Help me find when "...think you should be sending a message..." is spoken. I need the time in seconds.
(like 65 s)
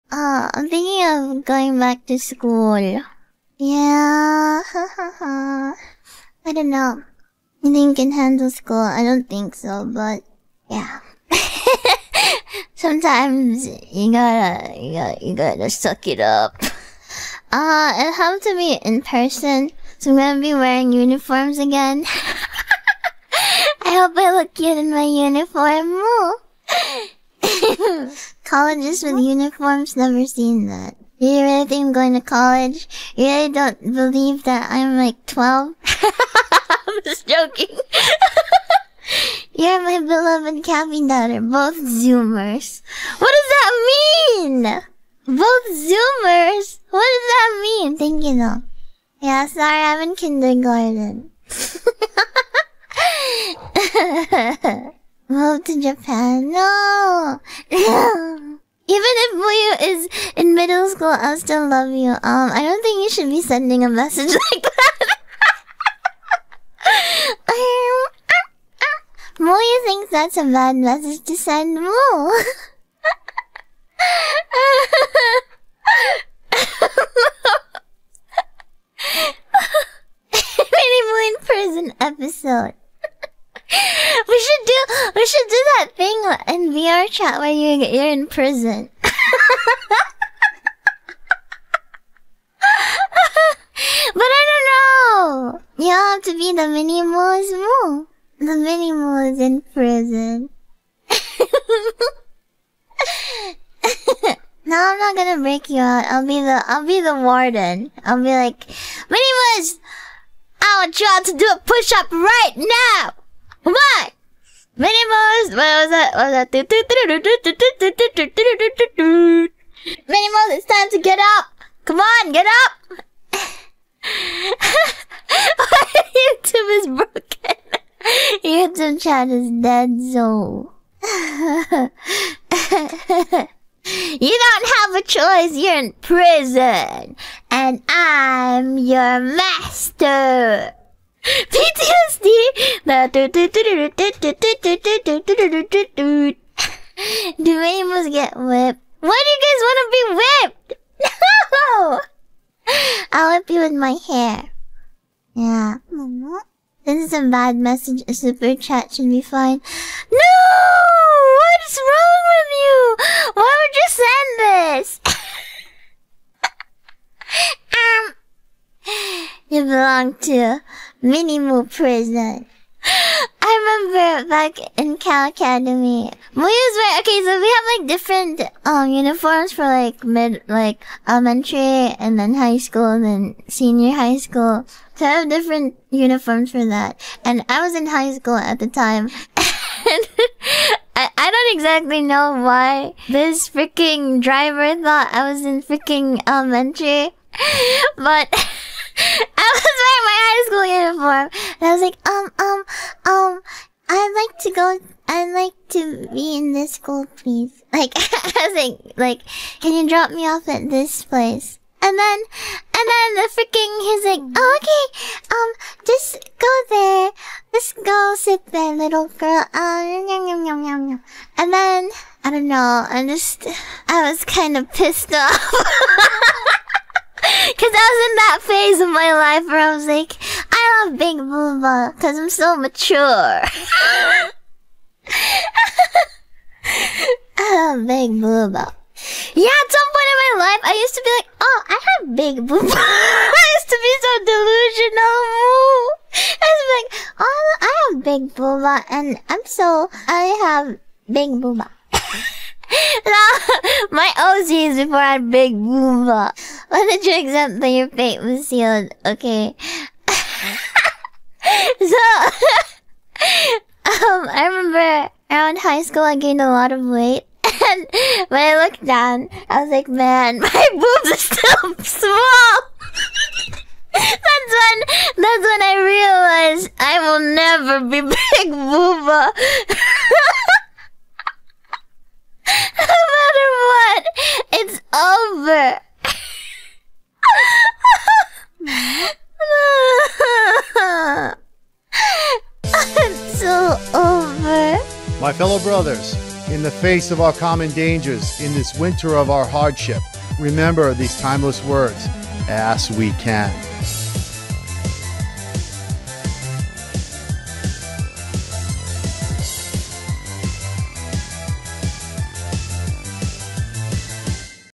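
62 s.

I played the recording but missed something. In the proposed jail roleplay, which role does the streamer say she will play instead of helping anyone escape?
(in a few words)
The warden.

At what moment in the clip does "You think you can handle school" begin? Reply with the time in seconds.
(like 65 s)
7 s.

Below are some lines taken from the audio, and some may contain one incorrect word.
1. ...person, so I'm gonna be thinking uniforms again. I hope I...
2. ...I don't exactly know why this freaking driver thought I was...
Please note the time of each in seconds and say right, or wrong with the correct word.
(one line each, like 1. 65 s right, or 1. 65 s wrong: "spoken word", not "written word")
1. 19 s wrong: "wearing", not "thinking"
2. 191 s right.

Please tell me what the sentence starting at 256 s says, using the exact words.
Let the drink something your fate was sealed, okay?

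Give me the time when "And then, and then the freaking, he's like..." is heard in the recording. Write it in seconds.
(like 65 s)
211 s.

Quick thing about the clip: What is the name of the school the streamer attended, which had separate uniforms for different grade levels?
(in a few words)
Cal Academy.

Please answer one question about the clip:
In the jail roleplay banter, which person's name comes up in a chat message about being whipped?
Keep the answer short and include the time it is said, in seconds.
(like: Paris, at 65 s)
Dwayne, at 147 s.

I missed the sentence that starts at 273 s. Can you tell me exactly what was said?
that's when, that's when I realized I will never be big booba.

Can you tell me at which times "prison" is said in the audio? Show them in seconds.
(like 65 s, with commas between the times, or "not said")
81 s, 88 s, 99 s, 136 s, 171 s.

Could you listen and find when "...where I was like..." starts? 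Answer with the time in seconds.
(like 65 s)
229 s.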